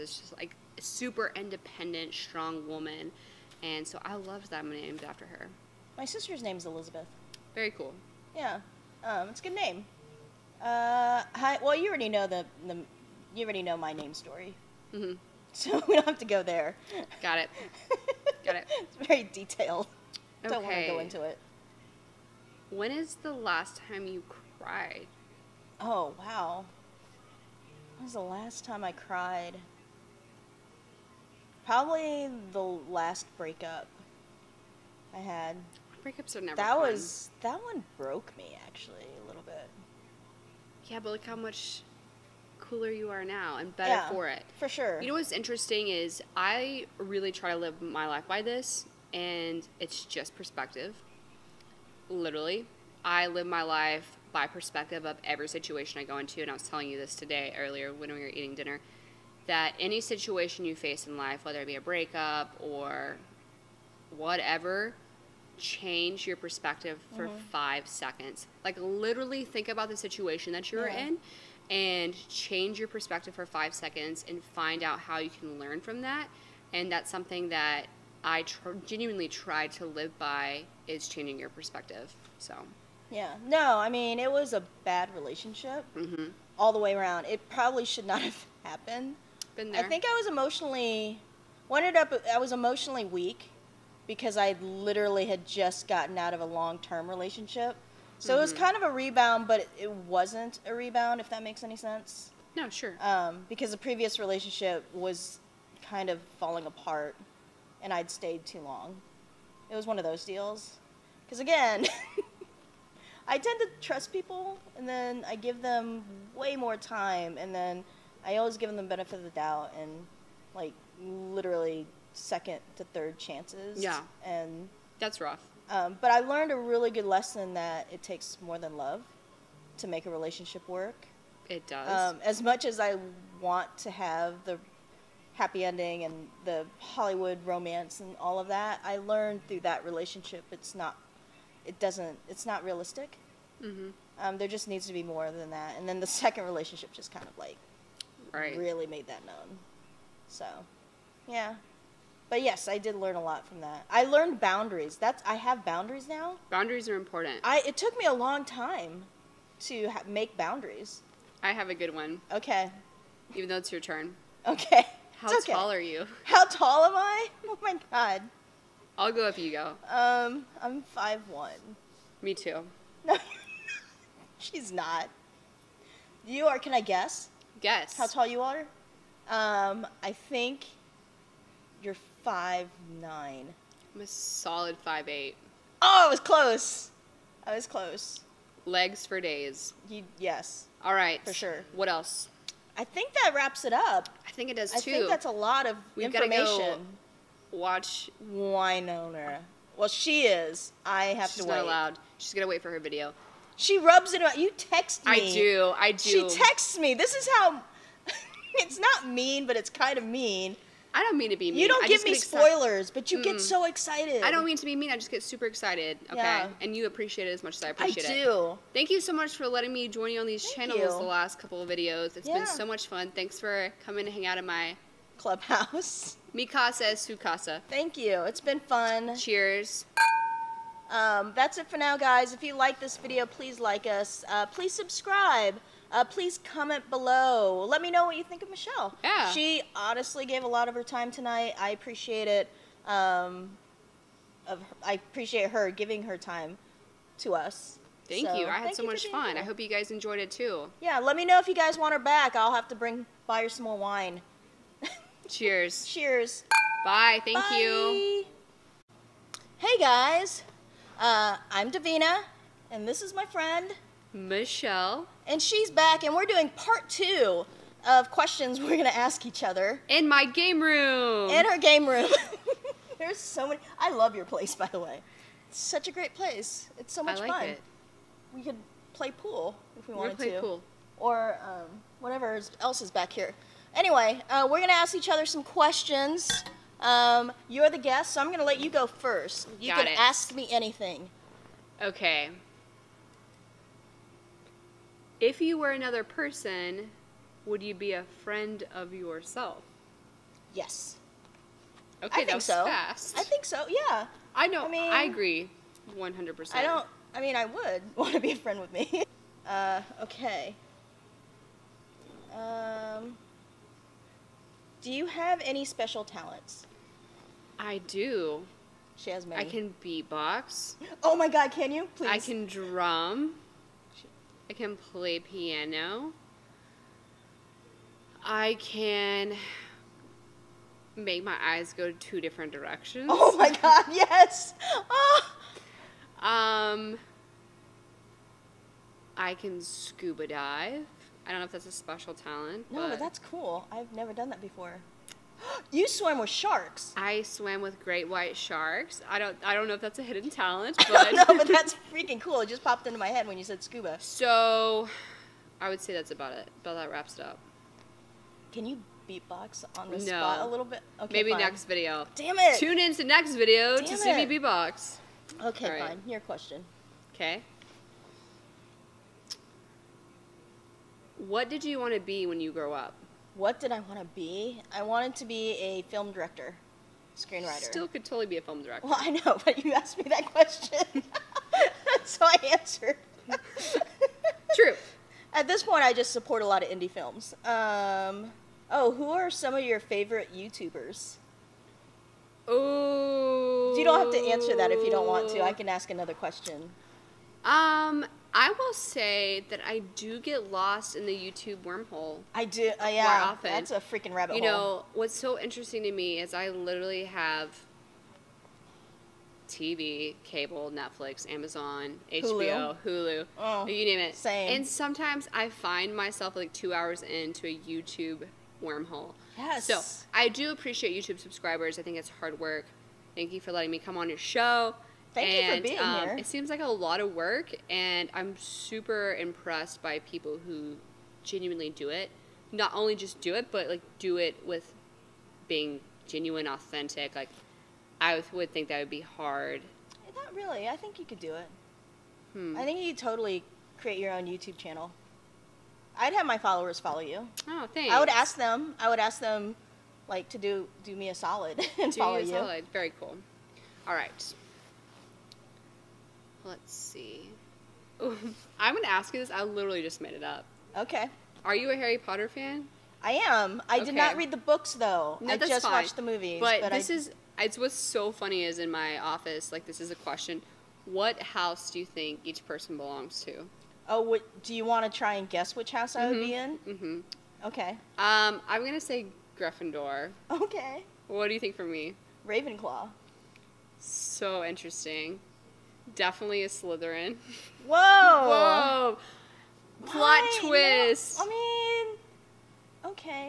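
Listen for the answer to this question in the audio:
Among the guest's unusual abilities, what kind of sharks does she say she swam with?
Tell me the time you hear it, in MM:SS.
05:47.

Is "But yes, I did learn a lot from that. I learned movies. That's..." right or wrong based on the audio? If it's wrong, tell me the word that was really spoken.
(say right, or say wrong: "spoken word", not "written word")
wrong: "boundaries", not "movies".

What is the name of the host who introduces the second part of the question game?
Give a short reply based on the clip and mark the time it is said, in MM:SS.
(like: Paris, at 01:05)
Davina, at 04:21.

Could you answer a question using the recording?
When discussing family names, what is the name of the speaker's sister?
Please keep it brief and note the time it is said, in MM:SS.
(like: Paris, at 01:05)
Elizabeth, at 00:06.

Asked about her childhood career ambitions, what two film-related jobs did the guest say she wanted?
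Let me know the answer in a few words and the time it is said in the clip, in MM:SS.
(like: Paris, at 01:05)
Film director, screenwriter, at 06:15.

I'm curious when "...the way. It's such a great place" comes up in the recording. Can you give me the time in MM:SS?
04:34.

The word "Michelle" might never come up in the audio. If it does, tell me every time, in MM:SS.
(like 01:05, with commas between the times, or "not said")
03:58, 04:24.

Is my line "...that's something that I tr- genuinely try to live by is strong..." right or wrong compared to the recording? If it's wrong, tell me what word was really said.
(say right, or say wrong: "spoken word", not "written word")
wrong: "changing", not "strong".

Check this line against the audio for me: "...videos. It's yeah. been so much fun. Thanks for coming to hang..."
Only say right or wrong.
right.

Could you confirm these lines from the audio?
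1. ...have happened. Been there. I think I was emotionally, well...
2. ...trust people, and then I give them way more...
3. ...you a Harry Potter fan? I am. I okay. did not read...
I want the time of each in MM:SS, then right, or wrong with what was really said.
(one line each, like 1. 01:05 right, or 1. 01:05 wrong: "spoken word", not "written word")
1. 01:28 right
2. 01:53 right
3. 07:41 right.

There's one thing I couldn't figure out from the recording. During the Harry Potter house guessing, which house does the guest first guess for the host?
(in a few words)
Gryffindor.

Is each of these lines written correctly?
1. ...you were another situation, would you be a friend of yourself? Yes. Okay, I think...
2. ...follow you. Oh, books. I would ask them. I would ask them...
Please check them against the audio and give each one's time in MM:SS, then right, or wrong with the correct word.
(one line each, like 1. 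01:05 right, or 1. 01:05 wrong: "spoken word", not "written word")
1. 04:55 wrong: "person", not "situation"
2. 07:26 wrong: "thanks", not "books".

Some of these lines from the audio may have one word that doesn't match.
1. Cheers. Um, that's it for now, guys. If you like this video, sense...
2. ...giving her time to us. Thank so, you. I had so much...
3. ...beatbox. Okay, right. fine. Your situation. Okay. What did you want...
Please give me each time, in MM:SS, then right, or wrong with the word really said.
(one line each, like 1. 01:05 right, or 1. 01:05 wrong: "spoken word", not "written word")
1. 03:49 wrong: "please", not "sense"
2. 04:05 right
3. 06:04 wrong: "question", not "situation".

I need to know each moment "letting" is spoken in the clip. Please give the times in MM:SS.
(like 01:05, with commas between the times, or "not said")
03:39, 07:03.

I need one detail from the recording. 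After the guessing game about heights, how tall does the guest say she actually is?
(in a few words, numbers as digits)
5'8".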